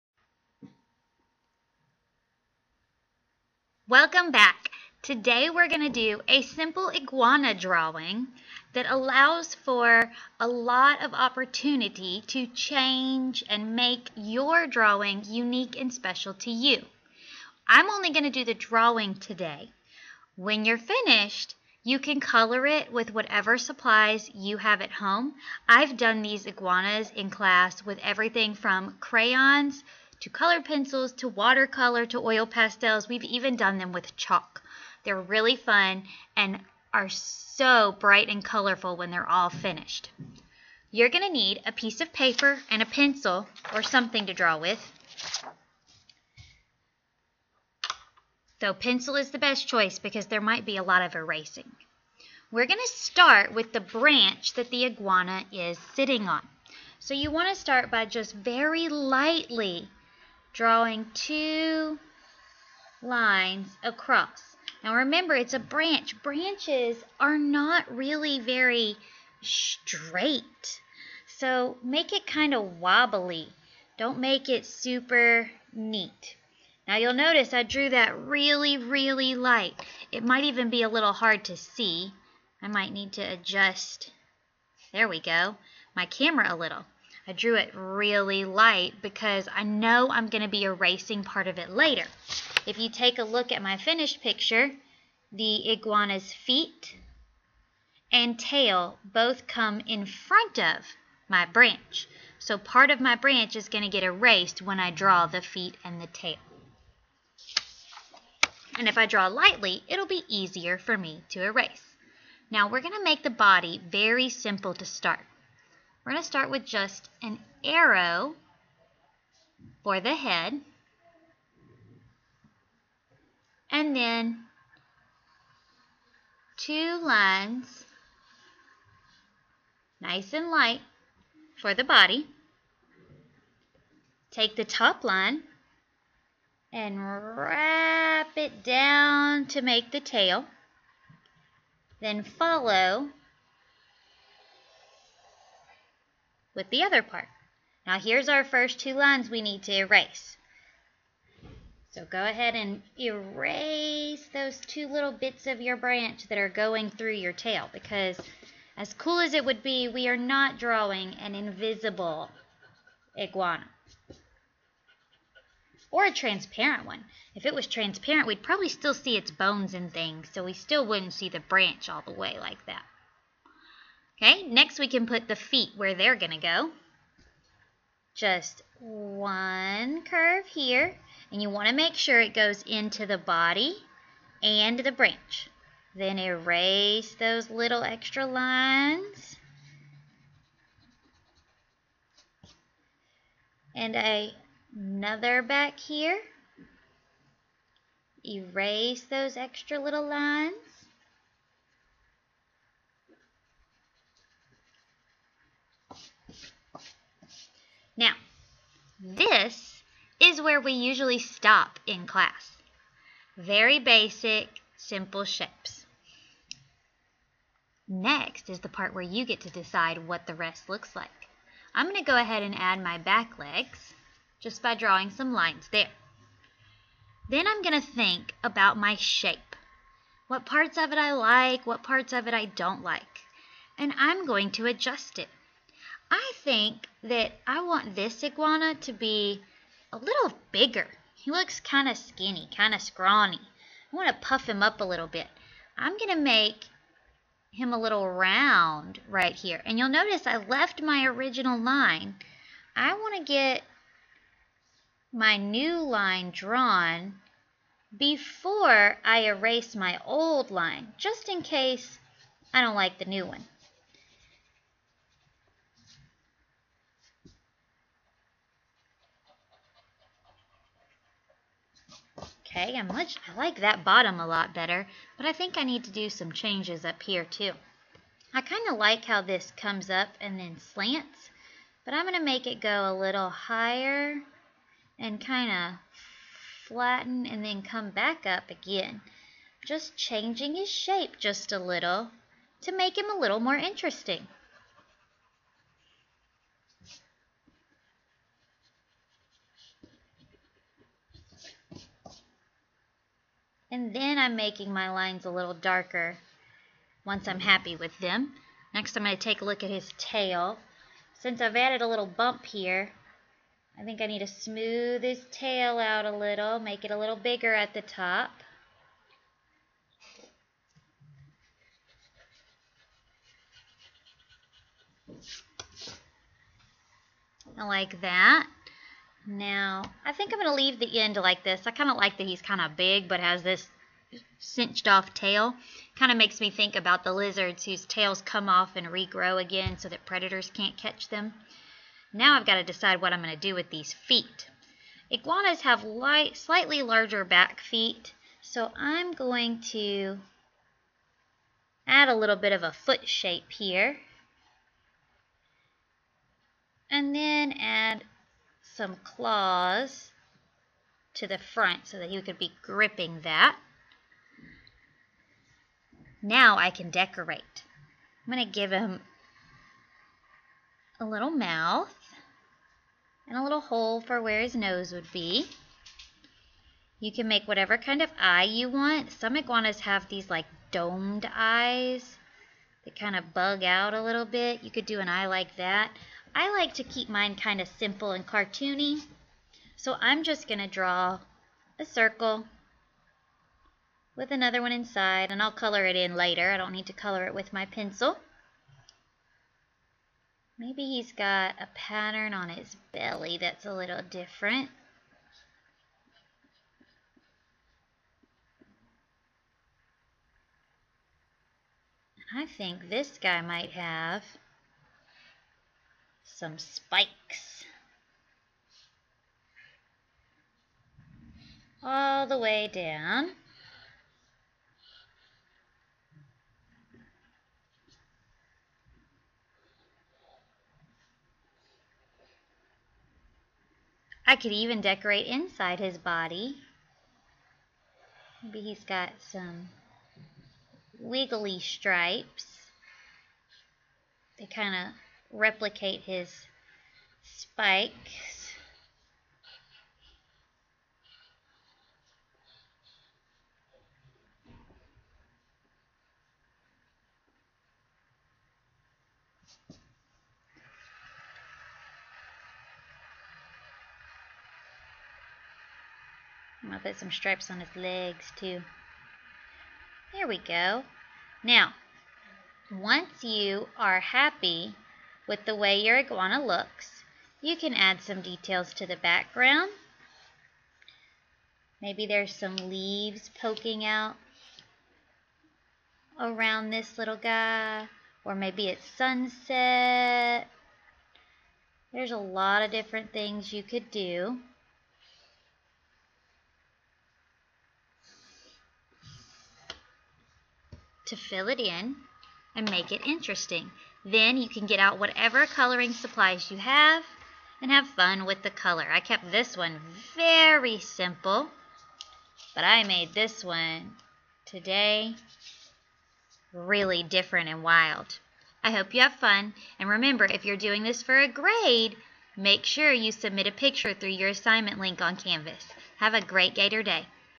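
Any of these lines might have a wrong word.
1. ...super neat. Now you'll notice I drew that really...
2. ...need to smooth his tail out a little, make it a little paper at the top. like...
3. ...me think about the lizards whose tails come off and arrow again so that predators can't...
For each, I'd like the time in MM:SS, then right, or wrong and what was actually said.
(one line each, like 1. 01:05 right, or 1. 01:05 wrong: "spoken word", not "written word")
1. 01:14 right
2. 05:14 wrong: "bigger", not "paper"
3. 05:36 wrong: "regrow", not "arrow".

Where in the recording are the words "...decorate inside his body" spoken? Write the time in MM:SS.
07:14.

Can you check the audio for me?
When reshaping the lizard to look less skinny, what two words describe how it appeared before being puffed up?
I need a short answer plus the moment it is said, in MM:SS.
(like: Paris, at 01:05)
kind of scrawny, at 04:02.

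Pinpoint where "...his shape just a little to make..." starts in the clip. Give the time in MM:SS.
04:50.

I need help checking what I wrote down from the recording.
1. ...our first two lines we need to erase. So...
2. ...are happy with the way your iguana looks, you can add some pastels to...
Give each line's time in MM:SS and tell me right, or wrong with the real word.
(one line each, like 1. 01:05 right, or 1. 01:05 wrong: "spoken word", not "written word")
1. 02:28 right
2. 07:53 wrong: "details", not "pastels".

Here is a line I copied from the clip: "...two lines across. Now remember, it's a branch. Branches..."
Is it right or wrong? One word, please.
right.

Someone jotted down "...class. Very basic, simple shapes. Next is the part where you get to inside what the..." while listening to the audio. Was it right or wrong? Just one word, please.
wrong.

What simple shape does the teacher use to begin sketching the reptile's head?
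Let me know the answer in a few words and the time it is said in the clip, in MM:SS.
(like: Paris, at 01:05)
an arrow, at 01:57.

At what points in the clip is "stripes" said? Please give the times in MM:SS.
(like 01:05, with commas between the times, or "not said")
07:21, 07:47.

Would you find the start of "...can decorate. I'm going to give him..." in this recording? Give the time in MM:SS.
06:06.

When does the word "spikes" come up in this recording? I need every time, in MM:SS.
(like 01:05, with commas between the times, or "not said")
06:56, 07:27.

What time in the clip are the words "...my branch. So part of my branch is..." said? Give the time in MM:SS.
01:41.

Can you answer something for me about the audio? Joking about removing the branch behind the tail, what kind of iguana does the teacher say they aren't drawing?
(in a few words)
invisible.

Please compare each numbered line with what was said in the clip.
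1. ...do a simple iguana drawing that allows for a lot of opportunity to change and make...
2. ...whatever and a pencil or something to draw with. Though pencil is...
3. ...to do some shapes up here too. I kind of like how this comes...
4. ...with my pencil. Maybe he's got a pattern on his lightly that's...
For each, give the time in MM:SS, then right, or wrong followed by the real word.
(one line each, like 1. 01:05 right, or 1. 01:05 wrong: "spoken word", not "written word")
1. 00:05 right
2. 00:42 wrong: "paper", not "whatever"
3. 04:35 wrong: "changes", not "shapes"
4. 06:37 wrong: "belly", not "lightly".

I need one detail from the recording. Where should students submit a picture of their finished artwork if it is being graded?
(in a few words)
Canvas.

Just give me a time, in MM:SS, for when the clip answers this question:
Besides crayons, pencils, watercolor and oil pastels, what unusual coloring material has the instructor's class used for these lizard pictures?
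00:34.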